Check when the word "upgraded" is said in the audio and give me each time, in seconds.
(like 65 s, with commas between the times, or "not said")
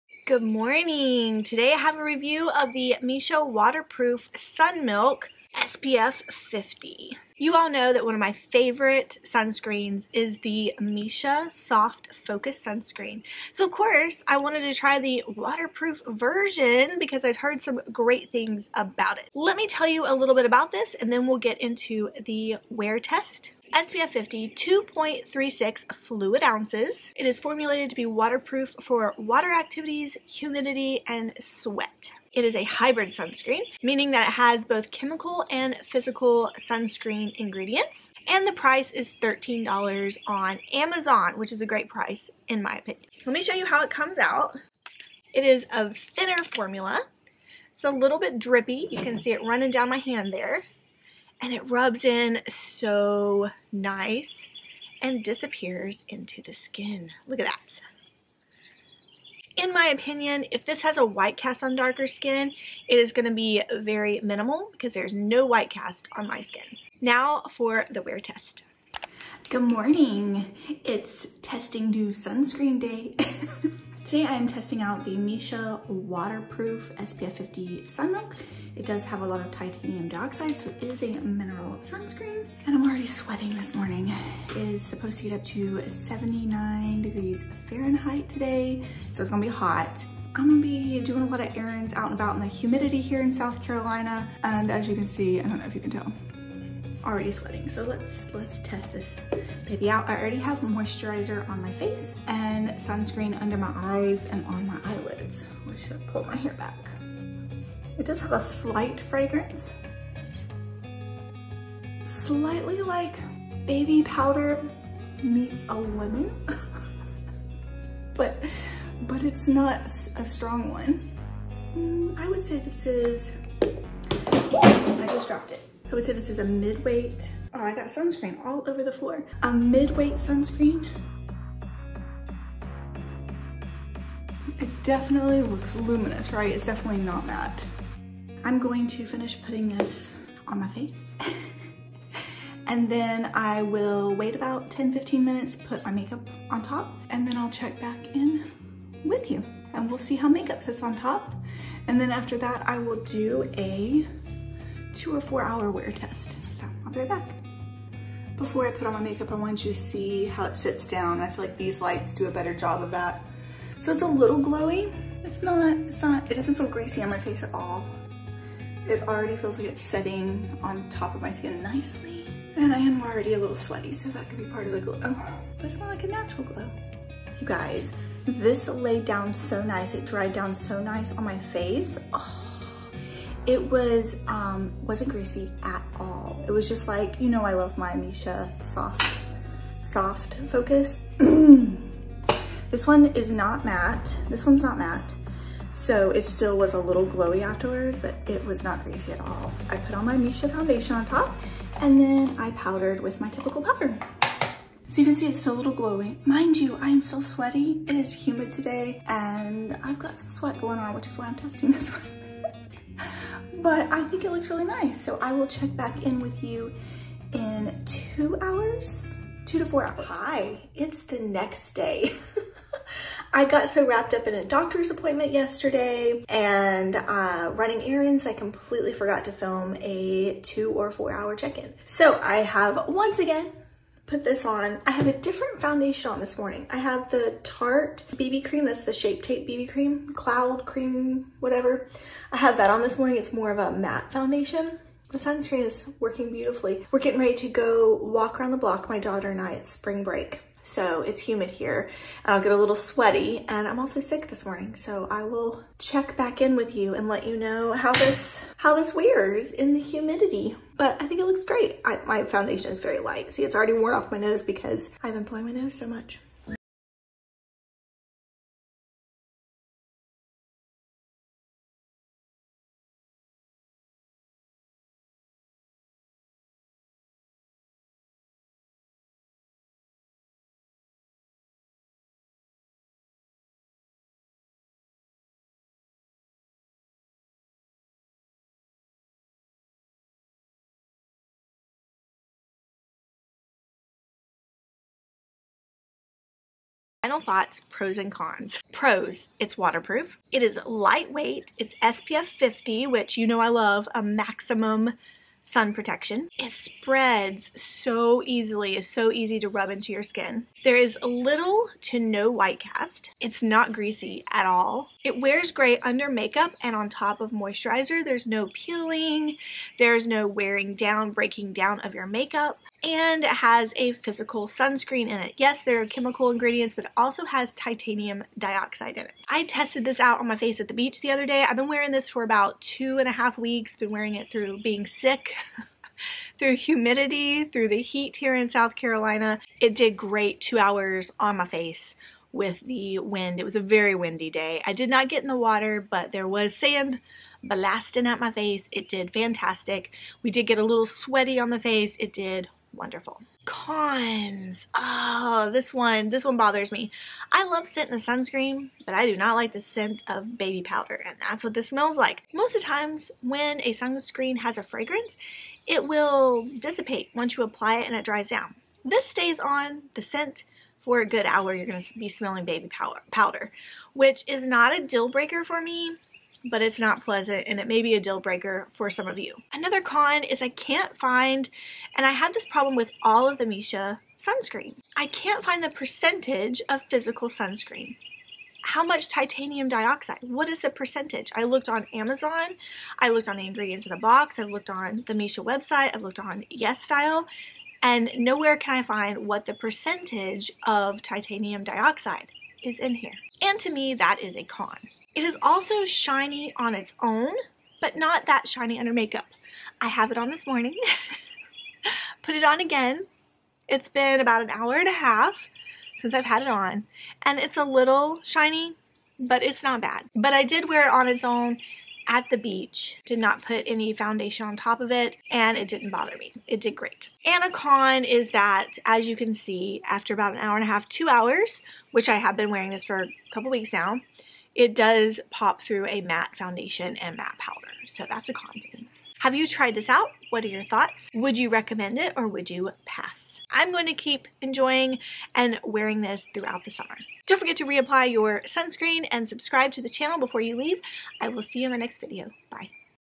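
not said.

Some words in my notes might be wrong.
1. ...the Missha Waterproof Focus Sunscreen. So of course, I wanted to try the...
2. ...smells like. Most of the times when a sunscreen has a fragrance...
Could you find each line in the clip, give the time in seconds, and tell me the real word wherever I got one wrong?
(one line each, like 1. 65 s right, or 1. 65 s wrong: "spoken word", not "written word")
1. 10 s wrong: "Soft", not "Waterproof"
2. 361 s right.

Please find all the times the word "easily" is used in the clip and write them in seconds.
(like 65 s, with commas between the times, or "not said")
308 s.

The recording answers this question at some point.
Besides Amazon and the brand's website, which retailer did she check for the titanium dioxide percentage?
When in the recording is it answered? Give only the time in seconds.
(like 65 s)
396 s.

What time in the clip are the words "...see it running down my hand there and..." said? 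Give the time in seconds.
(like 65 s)
49 s.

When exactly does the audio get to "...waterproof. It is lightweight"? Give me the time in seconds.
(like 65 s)
299 s.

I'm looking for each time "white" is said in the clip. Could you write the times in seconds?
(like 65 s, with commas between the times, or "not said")
61 s, 65 s, 312 s.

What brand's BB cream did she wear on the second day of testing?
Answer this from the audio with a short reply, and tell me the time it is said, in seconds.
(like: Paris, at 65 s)
Tarte, at 237 s.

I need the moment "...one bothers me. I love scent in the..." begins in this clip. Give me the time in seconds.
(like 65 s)
356 s.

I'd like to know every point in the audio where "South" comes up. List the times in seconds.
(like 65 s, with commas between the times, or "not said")
93 s, 338 s.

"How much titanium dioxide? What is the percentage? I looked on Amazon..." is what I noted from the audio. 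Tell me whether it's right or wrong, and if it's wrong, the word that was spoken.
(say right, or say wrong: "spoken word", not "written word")
right.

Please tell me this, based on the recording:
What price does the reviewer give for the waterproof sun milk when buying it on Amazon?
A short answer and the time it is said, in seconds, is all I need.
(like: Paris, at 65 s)
$13, at 39 s.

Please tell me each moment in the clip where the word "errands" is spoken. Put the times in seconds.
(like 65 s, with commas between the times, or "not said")
91 s, 227 s.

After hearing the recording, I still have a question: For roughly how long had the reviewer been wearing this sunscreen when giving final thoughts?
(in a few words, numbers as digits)
2 and a half weeks.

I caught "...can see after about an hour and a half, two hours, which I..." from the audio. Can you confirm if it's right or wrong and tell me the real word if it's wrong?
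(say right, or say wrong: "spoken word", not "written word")
right.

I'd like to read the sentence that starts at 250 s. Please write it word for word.
So it's humid here and I'll get a little sweaty and I'm also sick this morning.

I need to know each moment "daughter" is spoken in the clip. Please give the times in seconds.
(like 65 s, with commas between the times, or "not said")
248 s.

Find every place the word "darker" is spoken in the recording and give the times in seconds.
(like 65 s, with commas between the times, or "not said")
61 s.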